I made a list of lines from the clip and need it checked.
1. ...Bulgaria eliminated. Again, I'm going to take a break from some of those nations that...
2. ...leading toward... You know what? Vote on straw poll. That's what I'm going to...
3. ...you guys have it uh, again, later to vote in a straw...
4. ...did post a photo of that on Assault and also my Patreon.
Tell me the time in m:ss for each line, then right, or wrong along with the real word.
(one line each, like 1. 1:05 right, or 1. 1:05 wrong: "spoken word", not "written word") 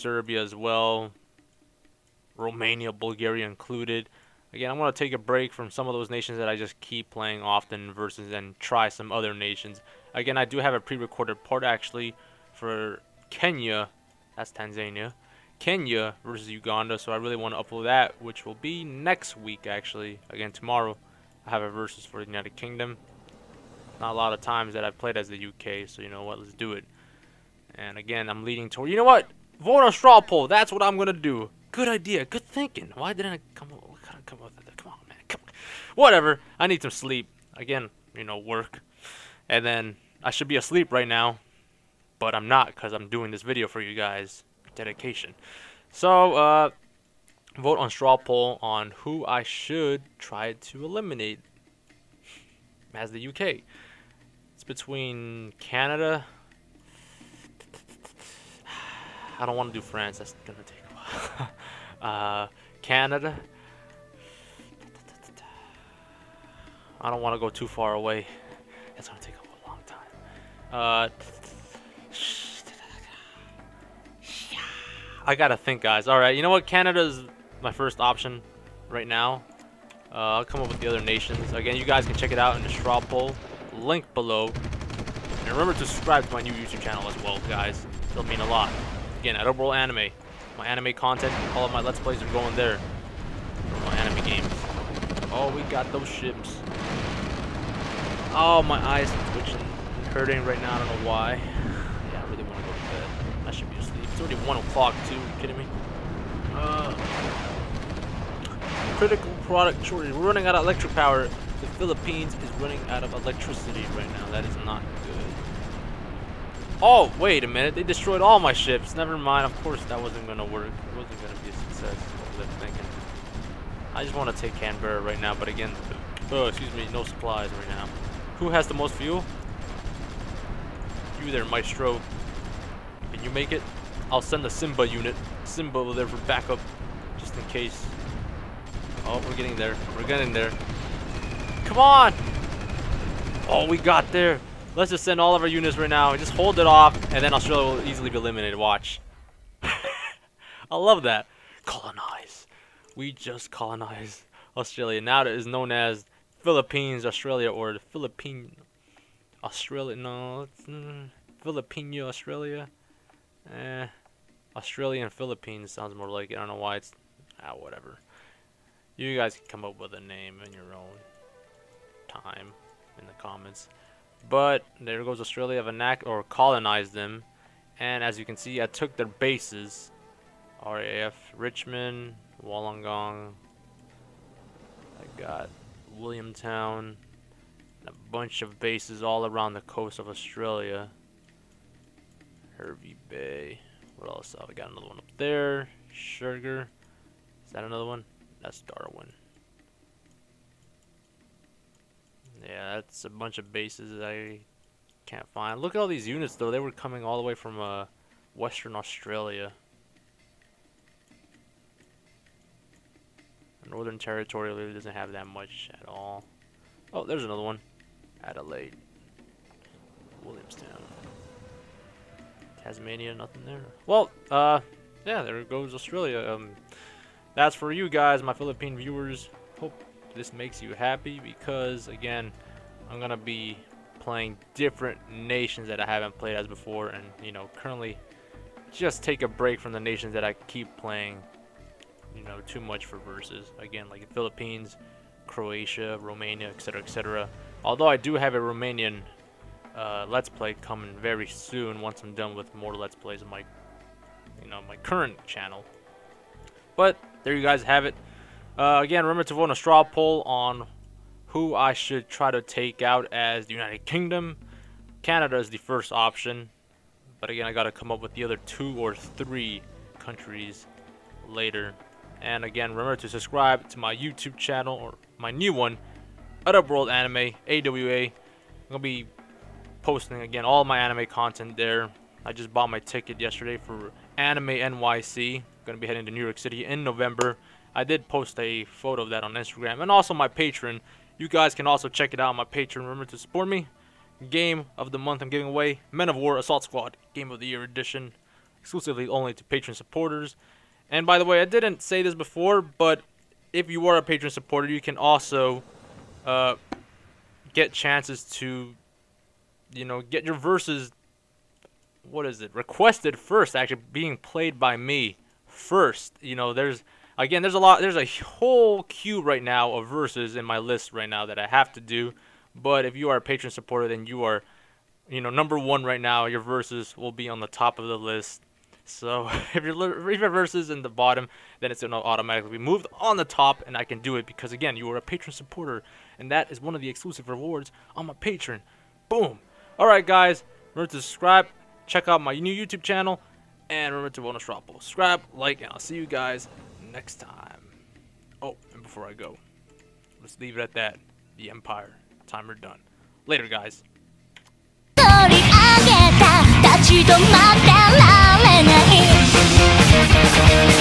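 1. 0:02 wrong: "included", not "eliminated"
2. 0:28 right
3. 4:17 wrong: "remember", not "later"
4. 4:47 wrong: "Instagram", not "Assault".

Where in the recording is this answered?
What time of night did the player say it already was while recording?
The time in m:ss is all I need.
1:44.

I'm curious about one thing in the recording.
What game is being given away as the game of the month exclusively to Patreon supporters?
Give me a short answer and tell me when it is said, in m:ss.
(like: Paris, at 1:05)
Men of War Assault Squad, at 4:55.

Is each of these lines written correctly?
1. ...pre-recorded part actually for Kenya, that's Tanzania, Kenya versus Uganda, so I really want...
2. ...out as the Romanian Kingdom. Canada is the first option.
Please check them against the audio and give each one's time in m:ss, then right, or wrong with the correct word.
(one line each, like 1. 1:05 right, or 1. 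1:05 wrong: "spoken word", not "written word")
1. 0:10 right
2. 4:22 wrong: "United", not "Romanian".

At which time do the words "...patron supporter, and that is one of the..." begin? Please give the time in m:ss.
5:35.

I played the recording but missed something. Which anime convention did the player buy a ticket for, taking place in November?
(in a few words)
Anime NYC.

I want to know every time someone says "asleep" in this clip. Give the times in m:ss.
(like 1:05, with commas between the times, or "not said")
0:40, 1:43.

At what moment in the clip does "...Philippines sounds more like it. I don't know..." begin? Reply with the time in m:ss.
2:45.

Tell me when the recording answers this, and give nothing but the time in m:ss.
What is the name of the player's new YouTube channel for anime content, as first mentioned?
1:29.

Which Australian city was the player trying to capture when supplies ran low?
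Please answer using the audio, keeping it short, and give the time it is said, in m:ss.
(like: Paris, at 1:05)
Canberra, at 2:04.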